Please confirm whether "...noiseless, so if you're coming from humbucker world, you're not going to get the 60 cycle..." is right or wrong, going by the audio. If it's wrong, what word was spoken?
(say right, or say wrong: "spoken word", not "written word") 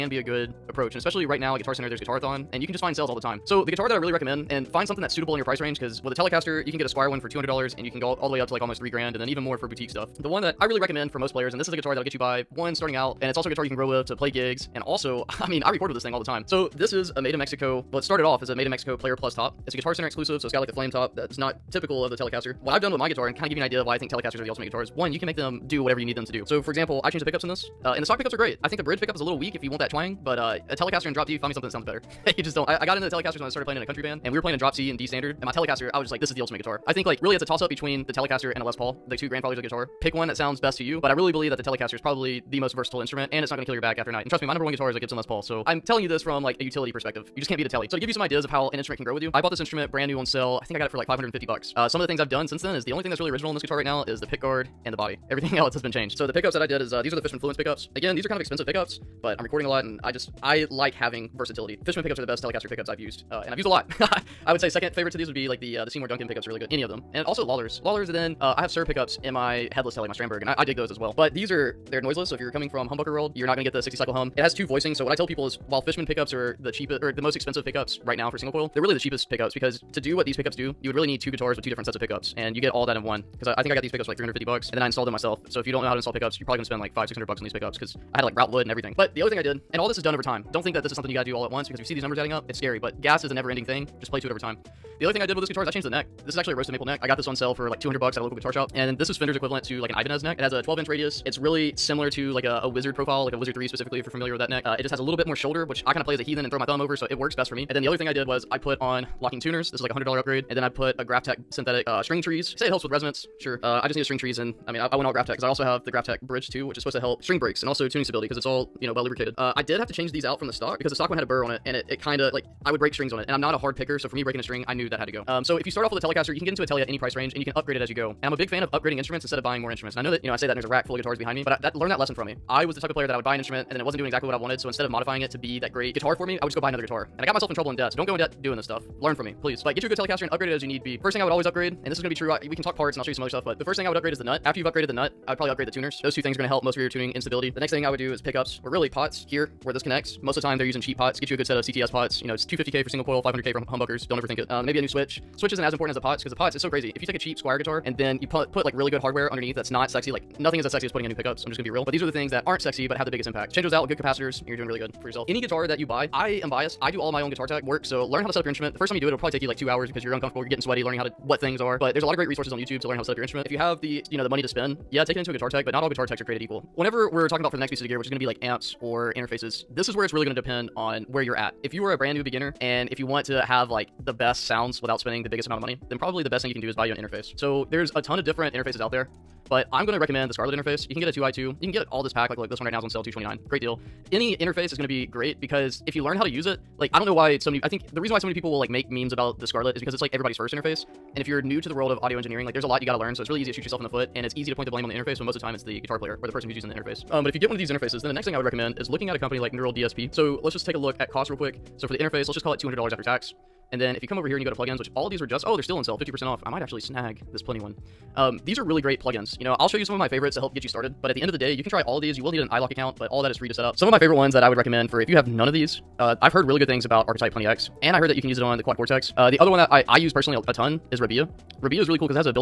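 right.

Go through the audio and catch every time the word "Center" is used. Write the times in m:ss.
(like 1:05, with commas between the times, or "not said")
0:01, 0:19.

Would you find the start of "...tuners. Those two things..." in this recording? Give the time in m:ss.
2:25.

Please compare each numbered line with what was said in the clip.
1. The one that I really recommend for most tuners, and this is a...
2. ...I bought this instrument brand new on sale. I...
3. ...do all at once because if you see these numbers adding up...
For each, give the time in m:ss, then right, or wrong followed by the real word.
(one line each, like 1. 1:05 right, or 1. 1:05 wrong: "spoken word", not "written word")
1. 0:10 wrong: "players", not "tuners"
2. 0:49 right
3. 1:31 right.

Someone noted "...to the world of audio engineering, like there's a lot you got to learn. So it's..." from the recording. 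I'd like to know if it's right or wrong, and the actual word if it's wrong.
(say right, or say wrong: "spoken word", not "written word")
right.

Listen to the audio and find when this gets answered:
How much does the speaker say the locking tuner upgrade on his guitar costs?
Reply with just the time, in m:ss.
1:49.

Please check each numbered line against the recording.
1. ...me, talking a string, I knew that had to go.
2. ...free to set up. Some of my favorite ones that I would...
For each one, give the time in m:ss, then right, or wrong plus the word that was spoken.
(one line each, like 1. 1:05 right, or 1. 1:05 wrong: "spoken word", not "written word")
1. 2:04 wrong: "breaking", not "talking"
2. 3:43 right.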